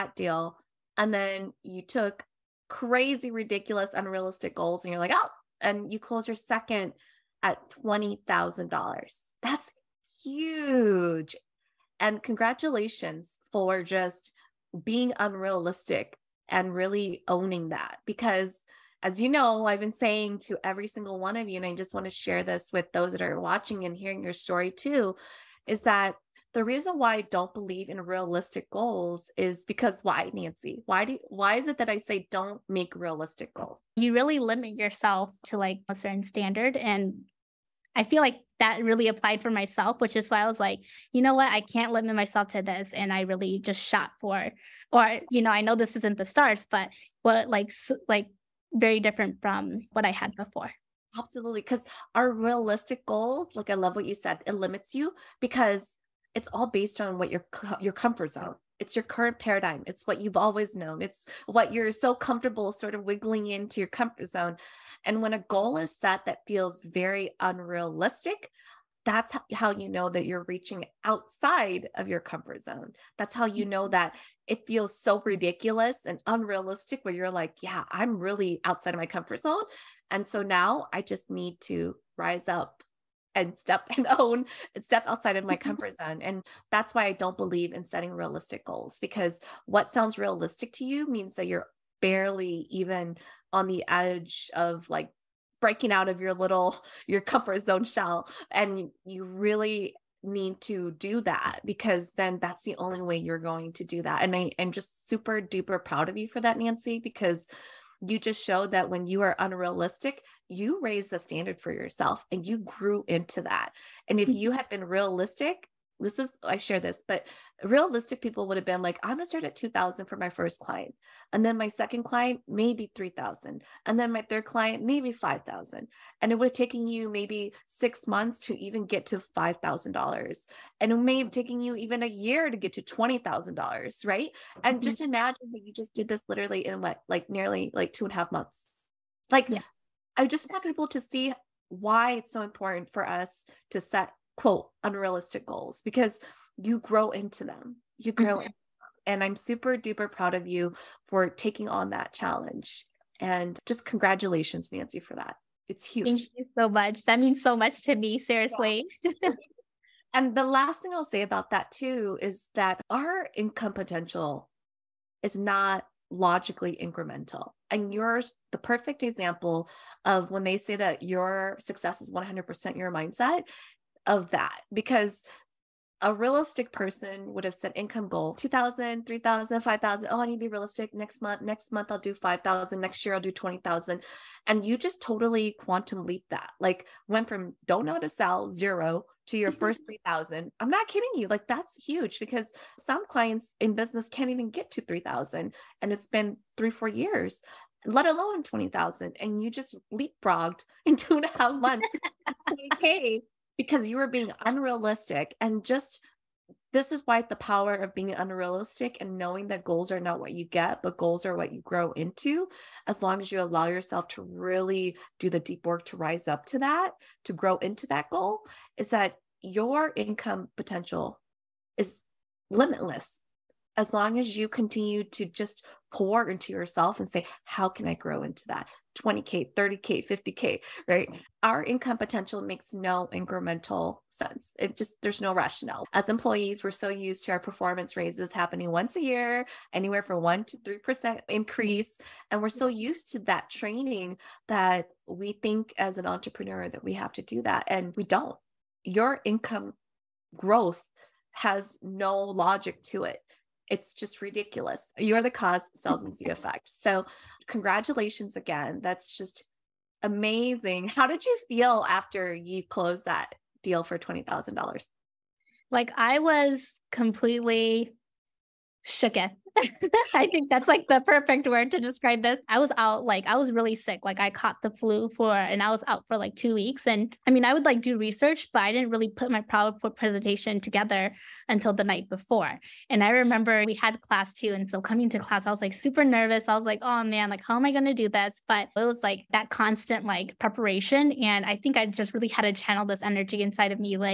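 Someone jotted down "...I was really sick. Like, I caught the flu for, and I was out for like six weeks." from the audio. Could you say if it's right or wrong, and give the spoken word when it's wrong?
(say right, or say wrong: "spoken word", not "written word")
wrong: "two", not "six".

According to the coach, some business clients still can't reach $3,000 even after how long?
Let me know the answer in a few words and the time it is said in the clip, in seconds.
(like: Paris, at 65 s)
3 or 4 years, at 196 s.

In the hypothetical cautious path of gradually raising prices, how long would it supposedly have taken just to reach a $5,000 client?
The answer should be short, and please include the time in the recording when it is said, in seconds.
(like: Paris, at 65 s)
6 months, at 127 s.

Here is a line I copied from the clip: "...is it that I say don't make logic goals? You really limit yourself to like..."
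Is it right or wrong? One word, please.
wrong.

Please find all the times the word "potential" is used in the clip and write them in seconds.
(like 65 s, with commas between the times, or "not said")
163 s, 220 s, 231 s.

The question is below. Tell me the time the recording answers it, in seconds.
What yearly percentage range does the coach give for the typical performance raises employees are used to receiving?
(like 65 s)
240 s.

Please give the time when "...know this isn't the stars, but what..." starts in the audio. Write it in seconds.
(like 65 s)
45 s.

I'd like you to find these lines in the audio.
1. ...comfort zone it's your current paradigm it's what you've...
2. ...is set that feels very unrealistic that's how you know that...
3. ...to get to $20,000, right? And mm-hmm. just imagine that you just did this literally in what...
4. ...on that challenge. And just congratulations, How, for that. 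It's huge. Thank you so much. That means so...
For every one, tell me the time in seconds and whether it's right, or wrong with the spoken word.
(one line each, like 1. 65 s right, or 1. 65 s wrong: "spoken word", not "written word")
1. 57 s right
2. 65 s right
3. 132 s right
4. 151 s wrong: "Nancy", not "How".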